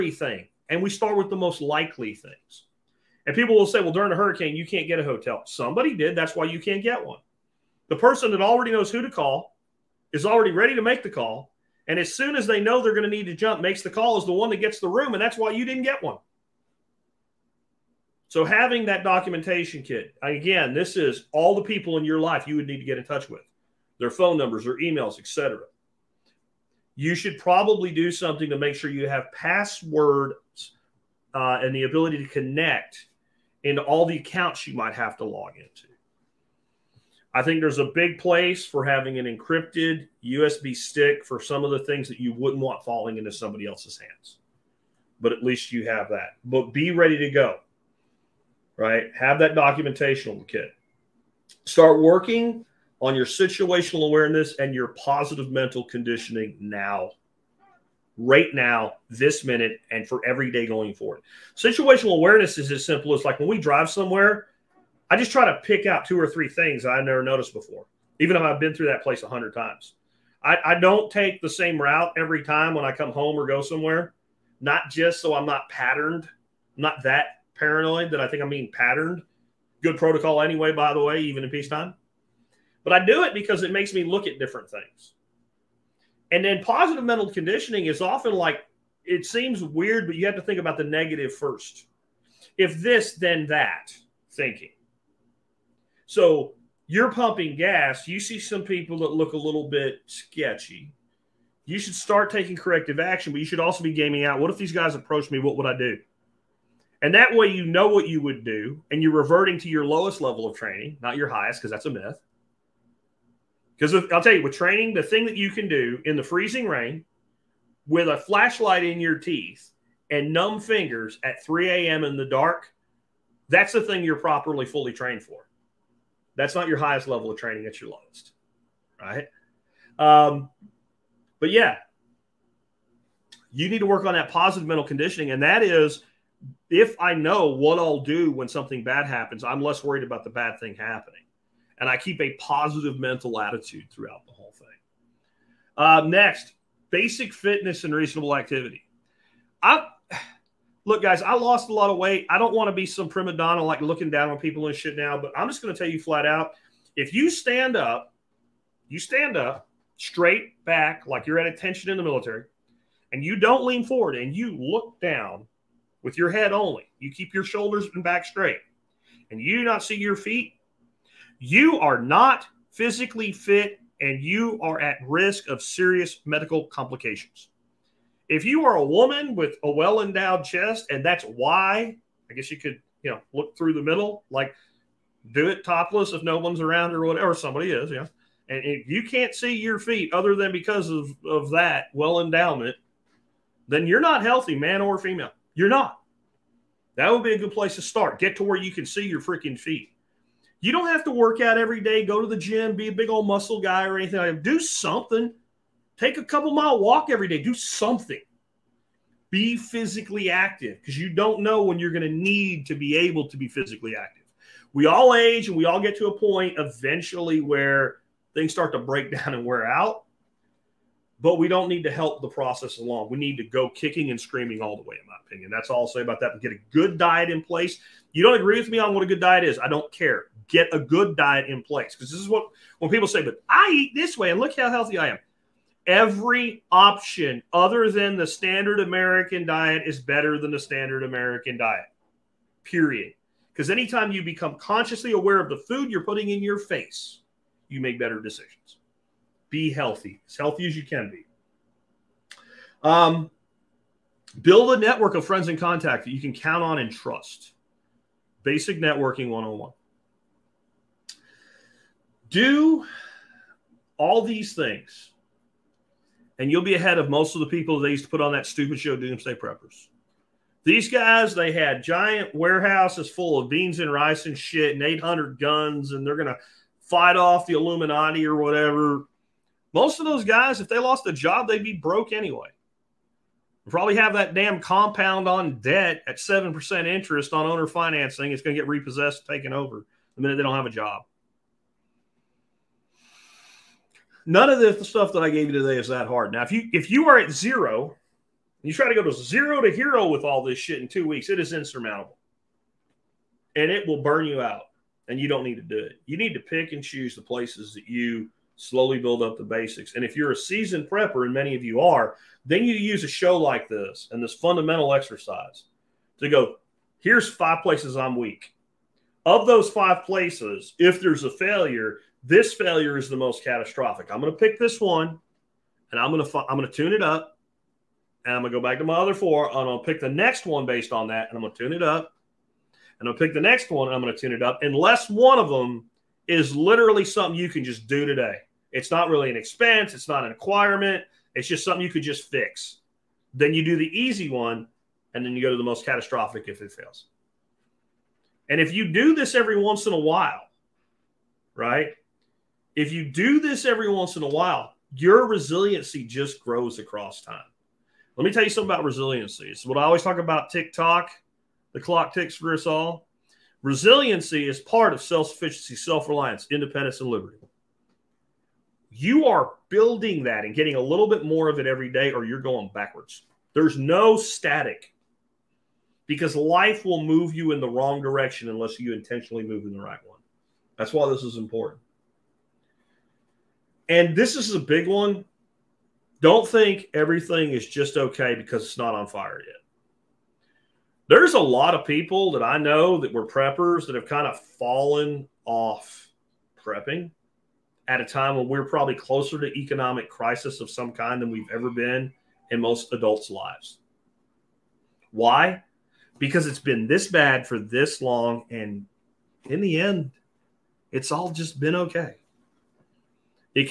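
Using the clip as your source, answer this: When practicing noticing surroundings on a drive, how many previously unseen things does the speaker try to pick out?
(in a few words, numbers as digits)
2 or 3.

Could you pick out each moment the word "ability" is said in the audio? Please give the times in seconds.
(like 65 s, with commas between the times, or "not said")
31 s.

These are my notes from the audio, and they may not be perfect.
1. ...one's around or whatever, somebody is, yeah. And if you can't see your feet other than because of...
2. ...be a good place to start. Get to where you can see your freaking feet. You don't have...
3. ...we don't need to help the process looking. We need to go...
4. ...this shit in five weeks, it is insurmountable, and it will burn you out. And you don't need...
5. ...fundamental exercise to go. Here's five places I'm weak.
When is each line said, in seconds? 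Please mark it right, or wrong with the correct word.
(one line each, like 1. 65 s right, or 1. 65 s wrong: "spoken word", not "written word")
1. 186 s right
2. 197 s right
3. 221 s wrong: "along", not "looking"
4. 300 s wrong: "two", not "five"
5. 314 s right.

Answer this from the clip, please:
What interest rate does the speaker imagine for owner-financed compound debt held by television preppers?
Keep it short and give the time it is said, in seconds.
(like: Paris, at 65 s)
7%, at 286 s.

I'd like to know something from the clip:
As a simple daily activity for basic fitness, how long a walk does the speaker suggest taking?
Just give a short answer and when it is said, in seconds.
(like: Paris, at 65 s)
a couple mile, at 206 s.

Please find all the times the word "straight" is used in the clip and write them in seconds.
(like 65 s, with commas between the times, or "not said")
159 s, 168 s.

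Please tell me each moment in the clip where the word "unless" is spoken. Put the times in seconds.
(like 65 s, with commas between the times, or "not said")
334 s, 378 s.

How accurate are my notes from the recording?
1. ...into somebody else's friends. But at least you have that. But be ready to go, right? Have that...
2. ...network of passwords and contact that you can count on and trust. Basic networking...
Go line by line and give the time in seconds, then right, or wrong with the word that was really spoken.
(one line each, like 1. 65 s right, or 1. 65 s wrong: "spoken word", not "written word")
1. 43 s wrong: "hands", not "friends"
2. 254 s wrong: "friends", not "passwords".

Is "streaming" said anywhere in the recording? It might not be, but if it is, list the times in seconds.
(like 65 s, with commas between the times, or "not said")
not said.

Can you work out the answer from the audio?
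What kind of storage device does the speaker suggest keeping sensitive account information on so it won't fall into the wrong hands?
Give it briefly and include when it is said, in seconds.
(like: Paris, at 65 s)
encrypted USB stick, at 39 s.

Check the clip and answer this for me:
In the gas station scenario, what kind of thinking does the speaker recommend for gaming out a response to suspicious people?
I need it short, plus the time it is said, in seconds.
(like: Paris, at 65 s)
If this, then that, at 92 s.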